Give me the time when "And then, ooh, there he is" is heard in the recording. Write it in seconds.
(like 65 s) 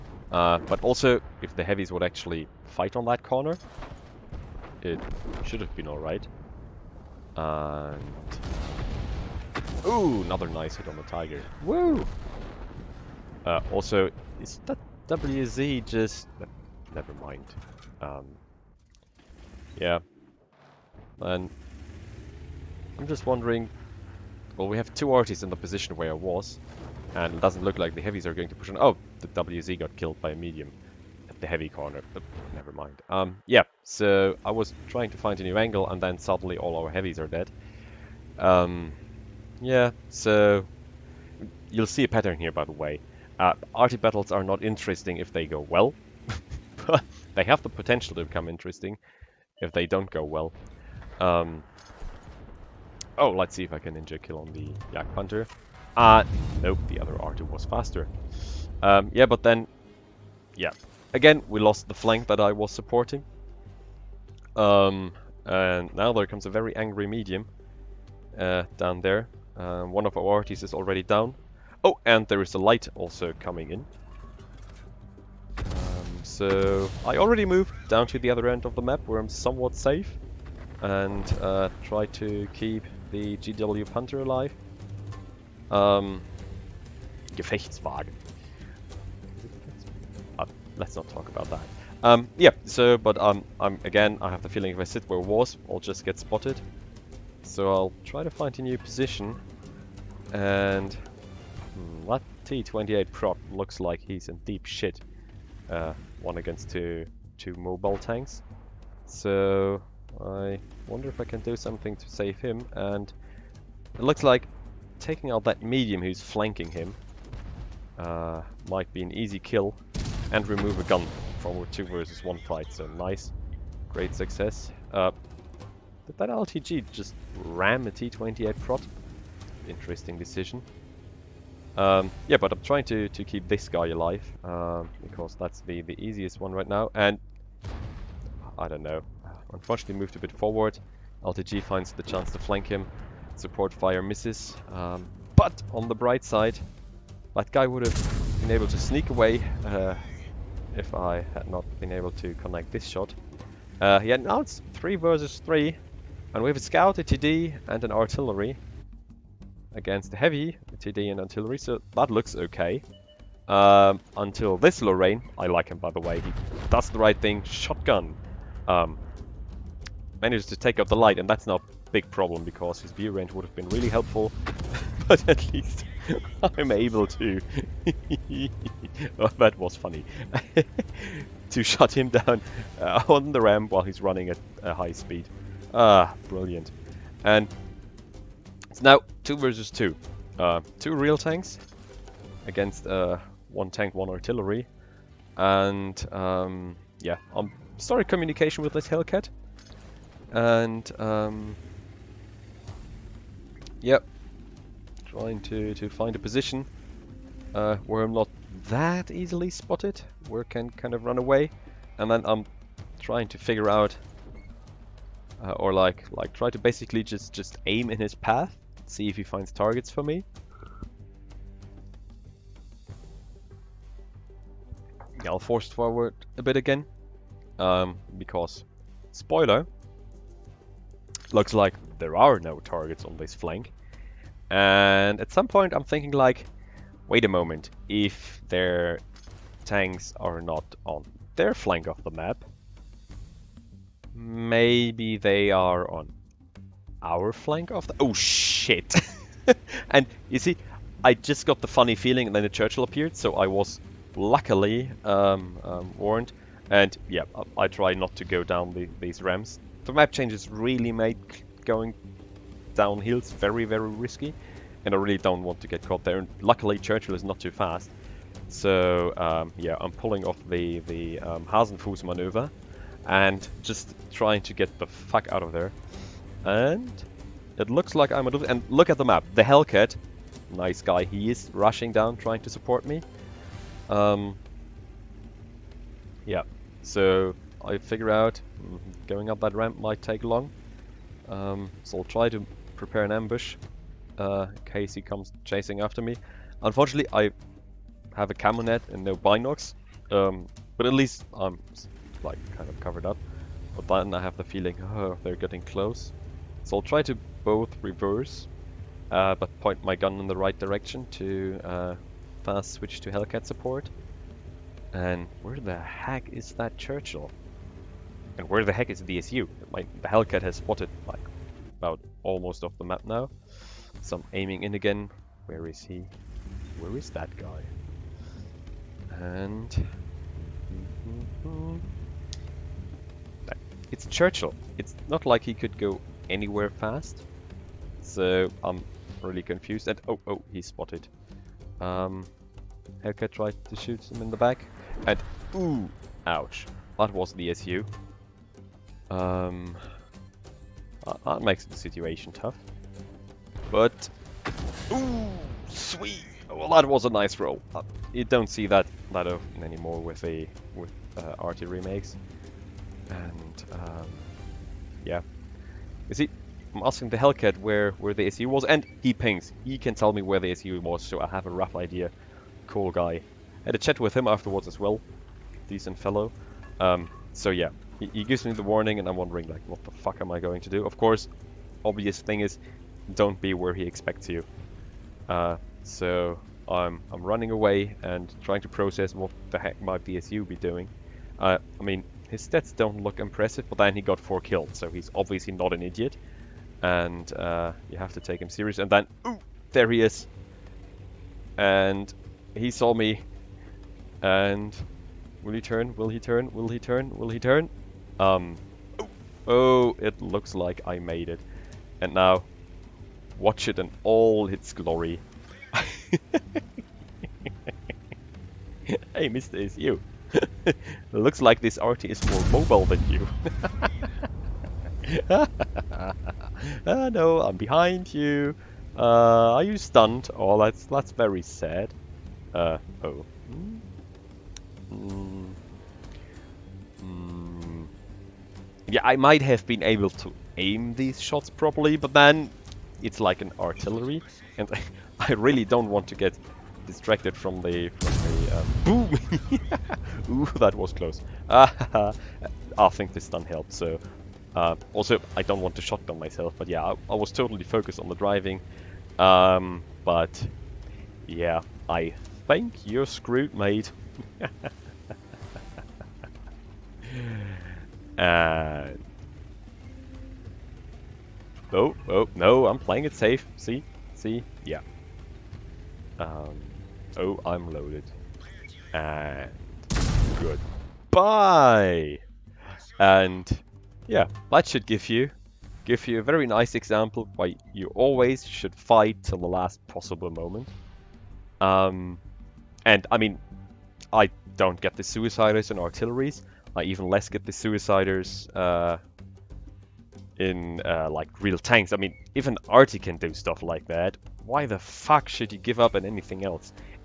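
398 s.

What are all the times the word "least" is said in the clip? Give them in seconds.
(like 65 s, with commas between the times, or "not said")
175 s, 300 s.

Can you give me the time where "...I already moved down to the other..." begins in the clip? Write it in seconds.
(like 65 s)
77 s.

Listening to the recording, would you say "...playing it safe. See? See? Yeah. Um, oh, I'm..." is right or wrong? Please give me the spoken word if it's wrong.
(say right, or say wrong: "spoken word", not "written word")
right.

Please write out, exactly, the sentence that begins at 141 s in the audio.
LTG finds the chance to flank him.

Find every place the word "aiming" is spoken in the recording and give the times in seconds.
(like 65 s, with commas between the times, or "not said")
324 s.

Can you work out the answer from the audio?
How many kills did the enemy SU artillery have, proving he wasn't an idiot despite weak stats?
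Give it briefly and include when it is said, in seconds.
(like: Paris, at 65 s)
4, at 394 s.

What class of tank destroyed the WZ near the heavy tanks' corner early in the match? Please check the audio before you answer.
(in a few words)
a medium.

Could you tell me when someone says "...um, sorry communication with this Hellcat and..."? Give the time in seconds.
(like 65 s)
197 s.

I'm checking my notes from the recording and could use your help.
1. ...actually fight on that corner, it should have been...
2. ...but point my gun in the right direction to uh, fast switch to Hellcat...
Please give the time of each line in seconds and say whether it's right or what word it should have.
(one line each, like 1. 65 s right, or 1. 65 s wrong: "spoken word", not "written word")
1. 2 s right
2. 309 s right.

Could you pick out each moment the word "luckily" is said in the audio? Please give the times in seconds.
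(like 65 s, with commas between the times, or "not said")
254 s, 266 s.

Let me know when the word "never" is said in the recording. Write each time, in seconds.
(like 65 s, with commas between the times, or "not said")
16 s, 32 s.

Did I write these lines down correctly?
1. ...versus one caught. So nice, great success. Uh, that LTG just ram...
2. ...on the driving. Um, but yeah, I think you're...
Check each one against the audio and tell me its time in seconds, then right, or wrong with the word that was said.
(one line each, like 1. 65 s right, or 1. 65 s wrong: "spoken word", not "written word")
1. 121 s wrong: "fight", not "caught"
2. 457 s right.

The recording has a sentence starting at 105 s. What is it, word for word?
Uh, one against two, two mobile tanks.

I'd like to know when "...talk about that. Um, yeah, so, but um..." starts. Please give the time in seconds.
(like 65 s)
91 s.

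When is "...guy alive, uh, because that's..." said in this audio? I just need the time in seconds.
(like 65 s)
133 s.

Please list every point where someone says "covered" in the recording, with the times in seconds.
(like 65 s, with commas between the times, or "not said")
302 s.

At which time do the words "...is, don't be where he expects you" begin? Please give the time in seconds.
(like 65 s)
382 s.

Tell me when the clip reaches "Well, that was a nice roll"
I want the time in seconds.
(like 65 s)
356 s.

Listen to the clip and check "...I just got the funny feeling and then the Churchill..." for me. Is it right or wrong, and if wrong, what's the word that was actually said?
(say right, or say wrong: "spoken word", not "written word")
right.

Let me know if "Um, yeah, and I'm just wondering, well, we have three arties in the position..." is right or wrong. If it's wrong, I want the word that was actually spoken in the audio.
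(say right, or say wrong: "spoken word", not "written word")
wrong: "two", not "three".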